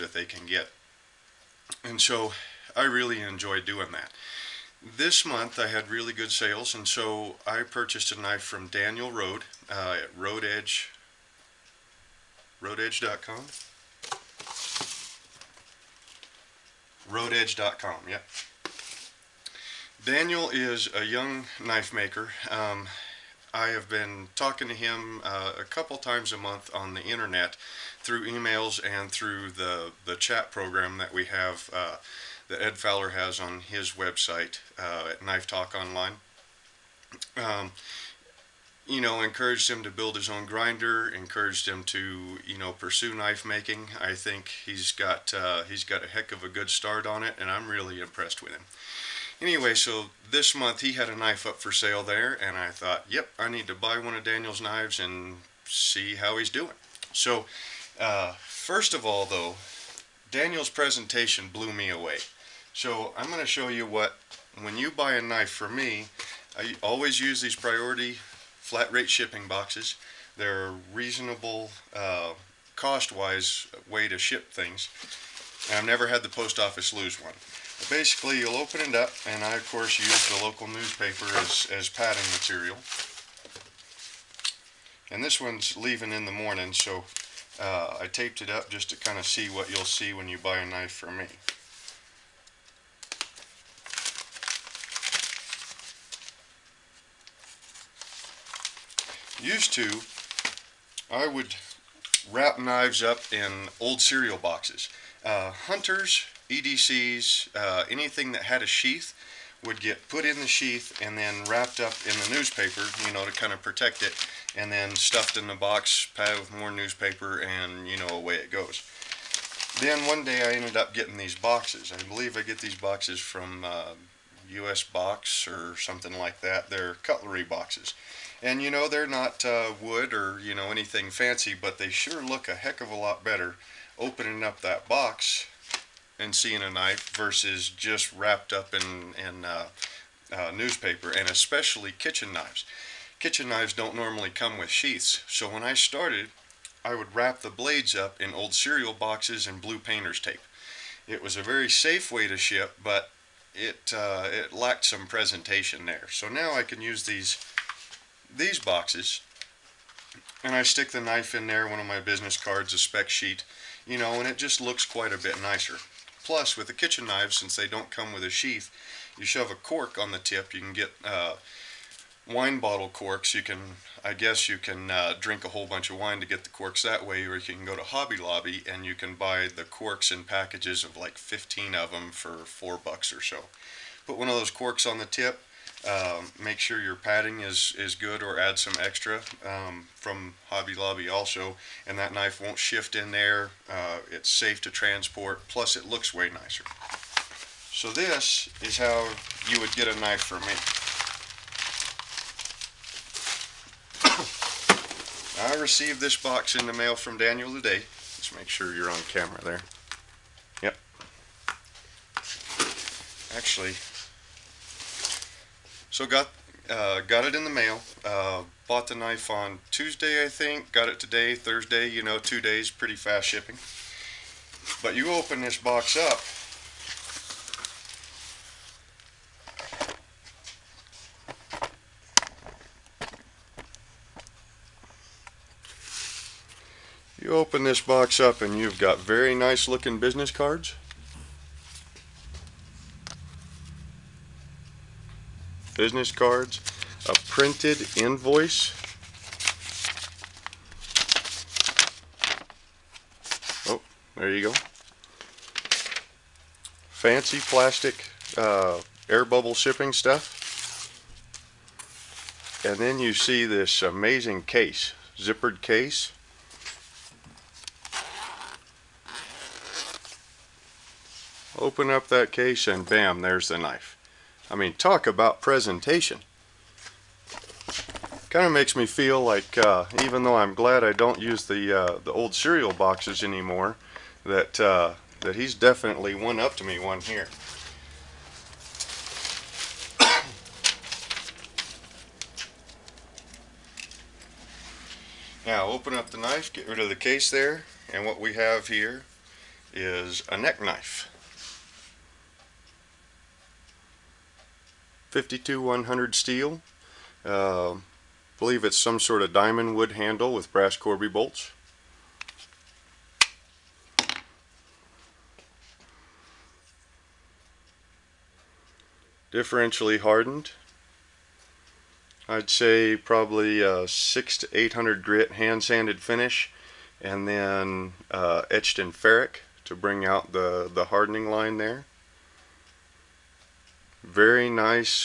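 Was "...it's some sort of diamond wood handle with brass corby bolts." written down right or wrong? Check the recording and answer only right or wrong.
right.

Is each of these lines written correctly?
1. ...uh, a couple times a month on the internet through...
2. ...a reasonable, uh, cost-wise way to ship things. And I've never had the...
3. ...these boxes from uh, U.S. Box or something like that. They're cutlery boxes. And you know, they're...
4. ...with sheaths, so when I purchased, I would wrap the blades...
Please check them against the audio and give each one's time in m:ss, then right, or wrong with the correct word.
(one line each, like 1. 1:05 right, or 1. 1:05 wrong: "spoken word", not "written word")
1. 0:25 right
2. 1:10 right
3. 2:02 right
4. 2:24 wrong: "started", not "purchased".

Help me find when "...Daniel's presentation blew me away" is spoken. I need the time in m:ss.
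1:00.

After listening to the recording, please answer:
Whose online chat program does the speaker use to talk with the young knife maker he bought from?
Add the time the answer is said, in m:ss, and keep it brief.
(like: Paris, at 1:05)
Ed Fowler, at 0:32.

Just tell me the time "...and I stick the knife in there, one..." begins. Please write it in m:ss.
2:40.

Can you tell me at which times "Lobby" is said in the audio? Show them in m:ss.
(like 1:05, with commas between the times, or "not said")
2:58, 3:10.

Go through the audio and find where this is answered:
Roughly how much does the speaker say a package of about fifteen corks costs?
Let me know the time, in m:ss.
3:02.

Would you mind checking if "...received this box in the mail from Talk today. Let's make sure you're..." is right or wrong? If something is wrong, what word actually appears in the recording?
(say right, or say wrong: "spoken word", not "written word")
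wrong: "Daniel", not "Talk".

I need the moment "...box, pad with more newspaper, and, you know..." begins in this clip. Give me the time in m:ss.
1:55.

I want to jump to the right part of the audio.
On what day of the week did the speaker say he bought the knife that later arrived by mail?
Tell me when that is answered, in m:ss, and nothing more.
3:39.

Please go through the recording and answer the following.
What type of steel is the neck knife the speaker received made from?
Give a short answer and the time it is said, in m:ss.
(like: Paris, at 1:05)
52100, at 5:05.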